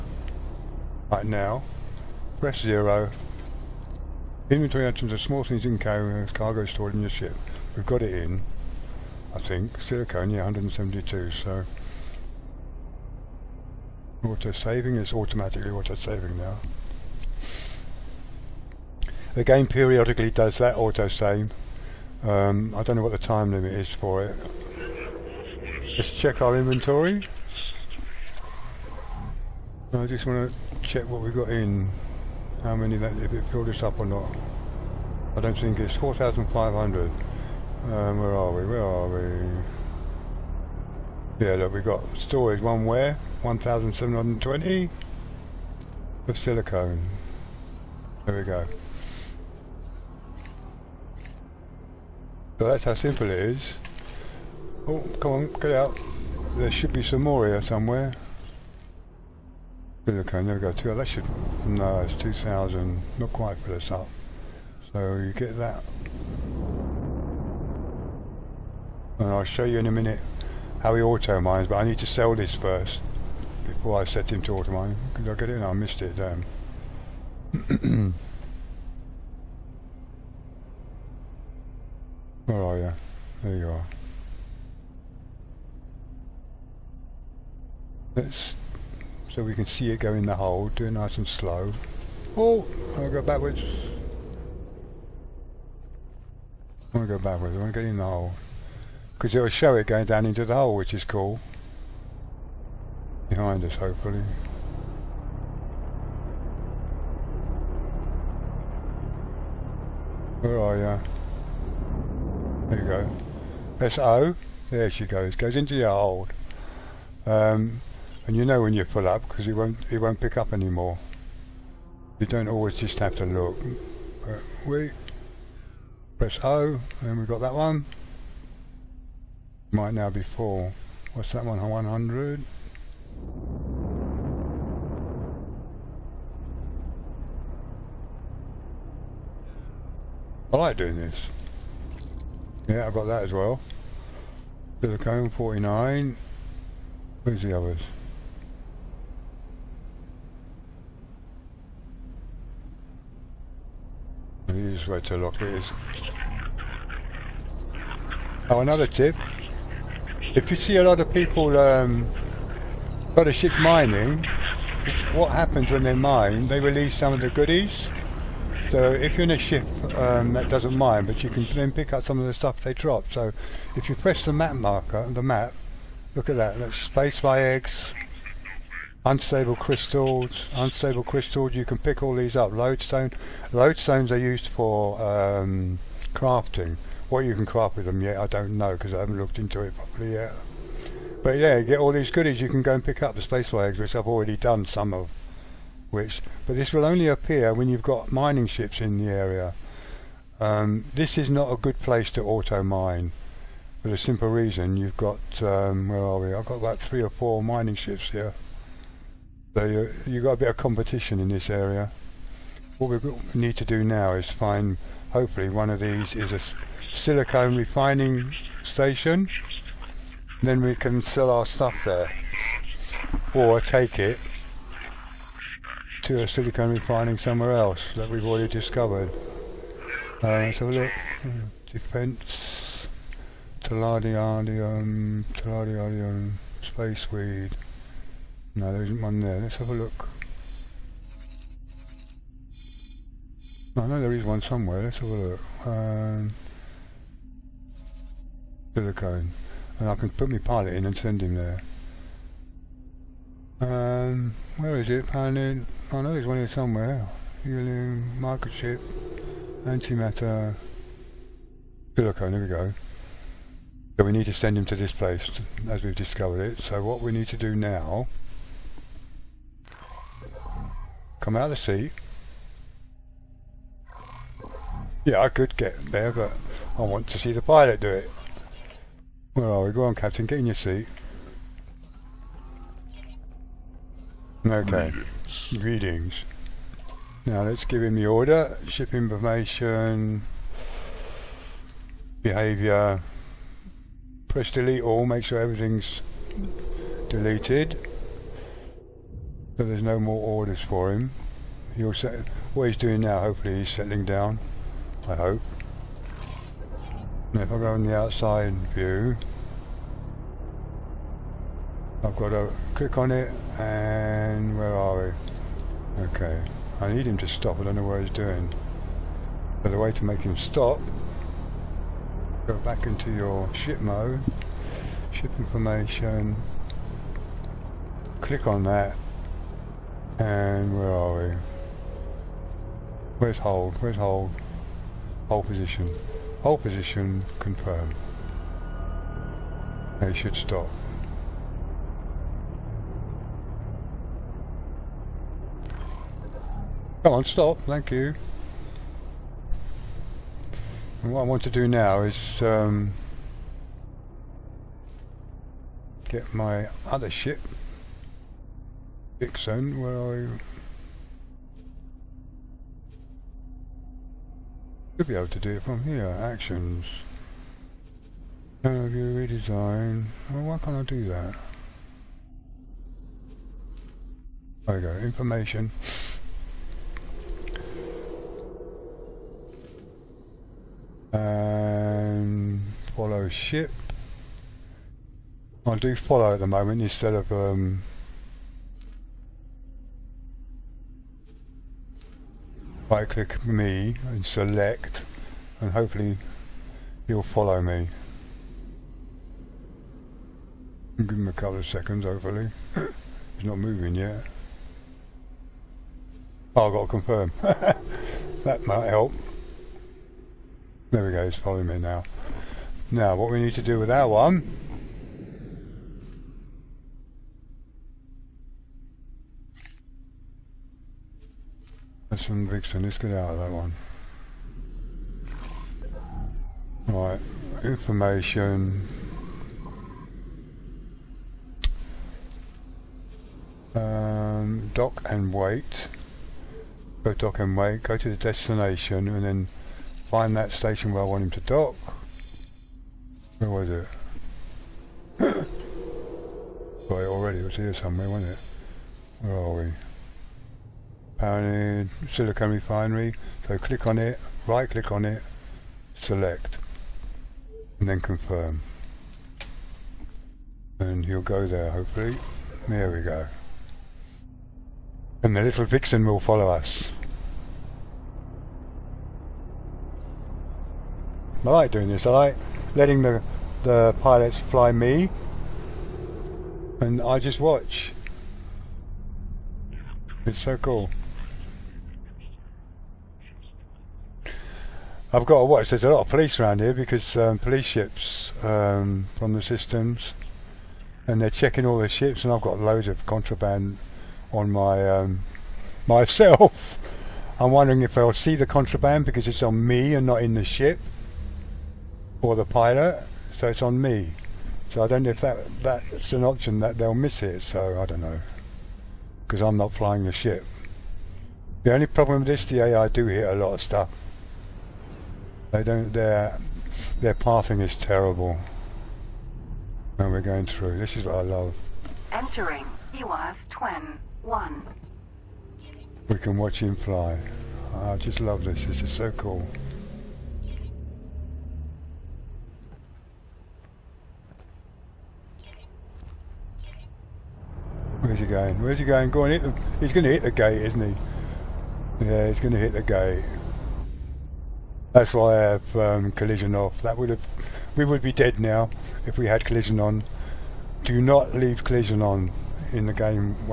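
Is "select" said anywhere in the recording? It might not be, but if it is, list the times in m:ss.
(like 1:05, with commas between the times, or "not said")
6:34, 7:35.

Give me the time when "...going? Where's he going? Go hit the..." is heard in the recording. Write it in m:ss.
8:58.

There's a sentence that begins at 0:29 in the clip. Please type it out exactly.
I just want to check what we've got in how many, if it filled us up or not.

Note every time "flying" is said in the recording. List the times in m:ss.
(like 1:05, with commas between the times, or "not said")
8:29.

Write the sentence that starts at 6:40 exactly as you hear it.
Give him a couple of seconds hopefully.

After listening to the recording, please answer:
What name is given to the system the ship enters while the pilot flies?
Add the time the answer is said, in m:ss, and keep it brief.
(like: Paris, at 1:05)
Hewa's Twin 1, at 8:42.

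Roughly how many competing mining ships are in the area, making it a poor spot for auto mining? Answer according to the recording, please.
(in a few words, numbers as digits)
three or four.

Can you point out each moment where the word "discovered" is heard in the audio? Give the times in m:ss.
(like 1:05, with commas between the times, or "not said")
3:48, 4:25.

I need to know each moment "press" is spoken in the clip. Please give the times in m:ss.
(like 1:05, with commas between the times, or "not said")
0:02, 1:53, 2:06, 2:53, 4:54.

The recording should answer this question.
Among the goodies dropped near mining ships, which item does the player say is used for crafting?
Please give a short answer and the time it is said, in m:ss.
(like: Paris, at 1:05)
Lodestone, at 3:03.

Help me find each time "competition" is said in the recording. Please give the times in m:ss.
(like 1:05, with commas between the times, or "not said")
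3:30.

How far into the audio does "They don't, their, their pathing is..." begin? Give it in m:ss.
8:35.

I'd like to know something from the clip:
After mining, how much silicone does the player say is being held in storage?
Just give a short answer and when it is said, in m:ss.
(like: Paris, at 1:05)
1,720, at 0:43.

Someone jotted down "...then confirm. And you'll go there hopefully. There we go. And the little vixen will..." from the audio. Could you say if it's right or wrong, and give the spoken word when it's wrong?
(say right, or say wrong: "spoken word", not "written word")
right.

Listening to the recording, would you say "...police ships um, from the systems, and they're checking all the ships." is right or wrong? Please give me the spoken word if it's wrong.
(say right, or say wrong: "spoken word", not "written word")
right.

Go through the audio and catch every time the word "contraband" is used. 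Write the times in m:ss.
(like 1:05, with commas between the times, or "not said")
8:13, 8:18.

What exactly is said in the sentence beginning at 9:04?
That's why I have um, collision off.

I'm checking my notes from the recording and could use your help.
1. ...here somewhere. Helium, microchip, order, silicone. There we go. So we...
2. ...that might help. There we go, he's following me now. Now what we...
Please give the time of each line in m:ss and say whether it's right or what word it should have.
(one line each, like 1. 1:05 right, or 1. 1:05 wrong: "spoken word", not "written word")
1. 4:16 wrong: "antimatter", not "order"
2. 6:48 right.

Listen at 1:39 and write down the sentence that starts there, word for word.
Because it'll show it going down into the hole, which is cool.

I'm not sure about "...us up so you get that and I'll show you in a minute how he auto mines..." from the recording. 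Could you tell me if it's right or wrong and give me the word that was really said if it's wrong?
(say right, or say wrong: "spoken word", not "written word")
right.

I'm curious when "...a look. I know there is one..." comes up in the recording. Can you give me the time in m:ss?
3:59.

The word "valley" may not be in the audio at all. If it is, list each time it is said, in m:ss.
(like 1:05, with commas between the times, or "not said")
not said.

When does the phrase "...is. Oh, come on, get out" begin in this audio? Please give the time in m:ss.
0:53.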